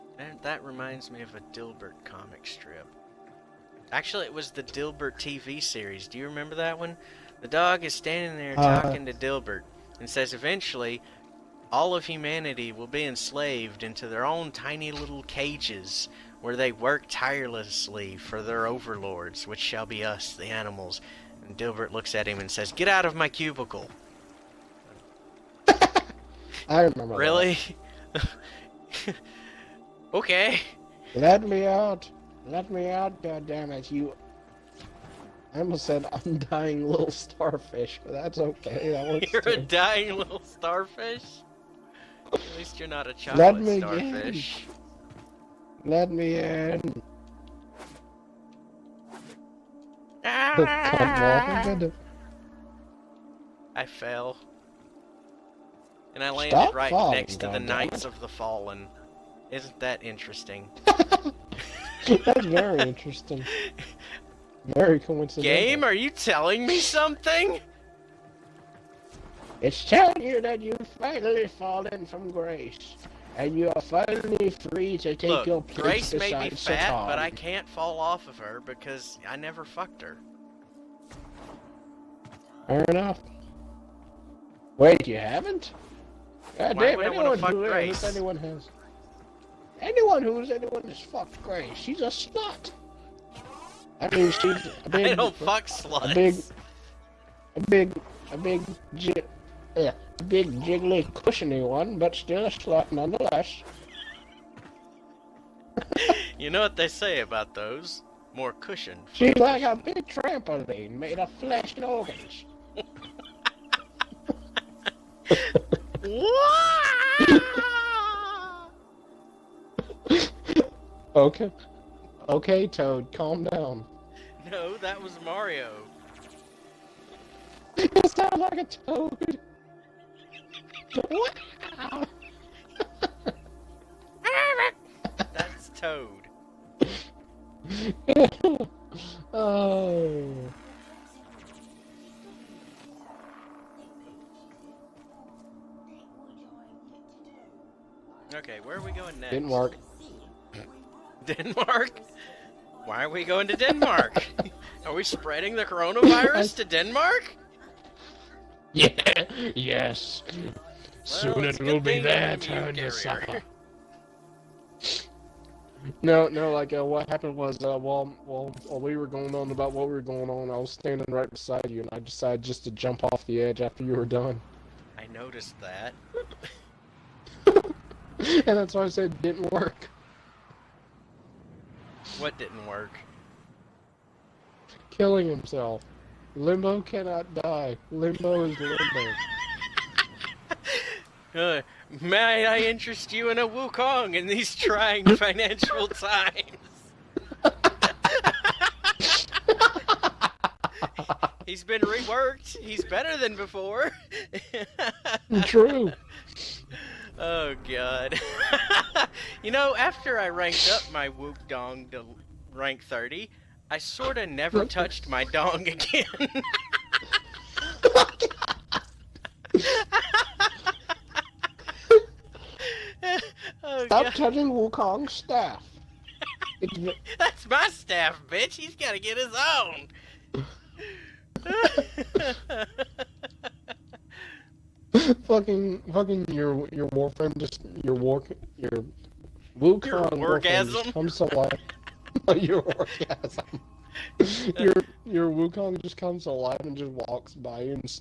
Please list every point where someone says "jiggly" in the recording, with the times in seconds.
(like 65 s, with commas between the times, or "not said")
100 s.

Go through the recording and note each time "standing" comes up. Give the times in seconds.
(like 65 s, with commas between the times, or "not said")
7 s, 170 s.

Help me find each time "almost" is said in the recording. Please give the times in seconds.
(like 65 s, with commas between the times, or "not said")
35 s.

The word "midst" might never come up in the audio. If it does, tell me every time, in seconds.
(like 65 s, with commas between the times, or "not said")
not said.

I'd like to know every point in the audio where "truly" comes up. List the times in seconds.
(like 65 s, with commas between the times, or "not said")
not said.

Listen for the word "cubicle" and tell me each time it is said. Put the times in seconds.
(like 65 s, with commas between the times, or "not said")
23 s.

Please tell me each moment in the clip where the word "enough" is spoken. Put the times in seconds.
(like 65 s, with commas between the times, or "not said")
82 s.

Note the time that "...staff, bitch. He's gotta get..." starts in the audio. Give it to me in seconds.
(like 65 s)
227 s.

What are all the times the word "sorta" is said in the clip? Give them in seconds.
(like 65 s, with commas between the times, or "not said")
213 s.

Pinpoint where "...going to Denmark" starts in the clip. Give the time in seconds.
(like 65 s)
153 s.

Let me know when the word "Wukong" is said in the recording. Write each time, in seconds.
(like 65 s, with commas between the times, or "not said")
193 s, 224 s, 239 s, 245 s.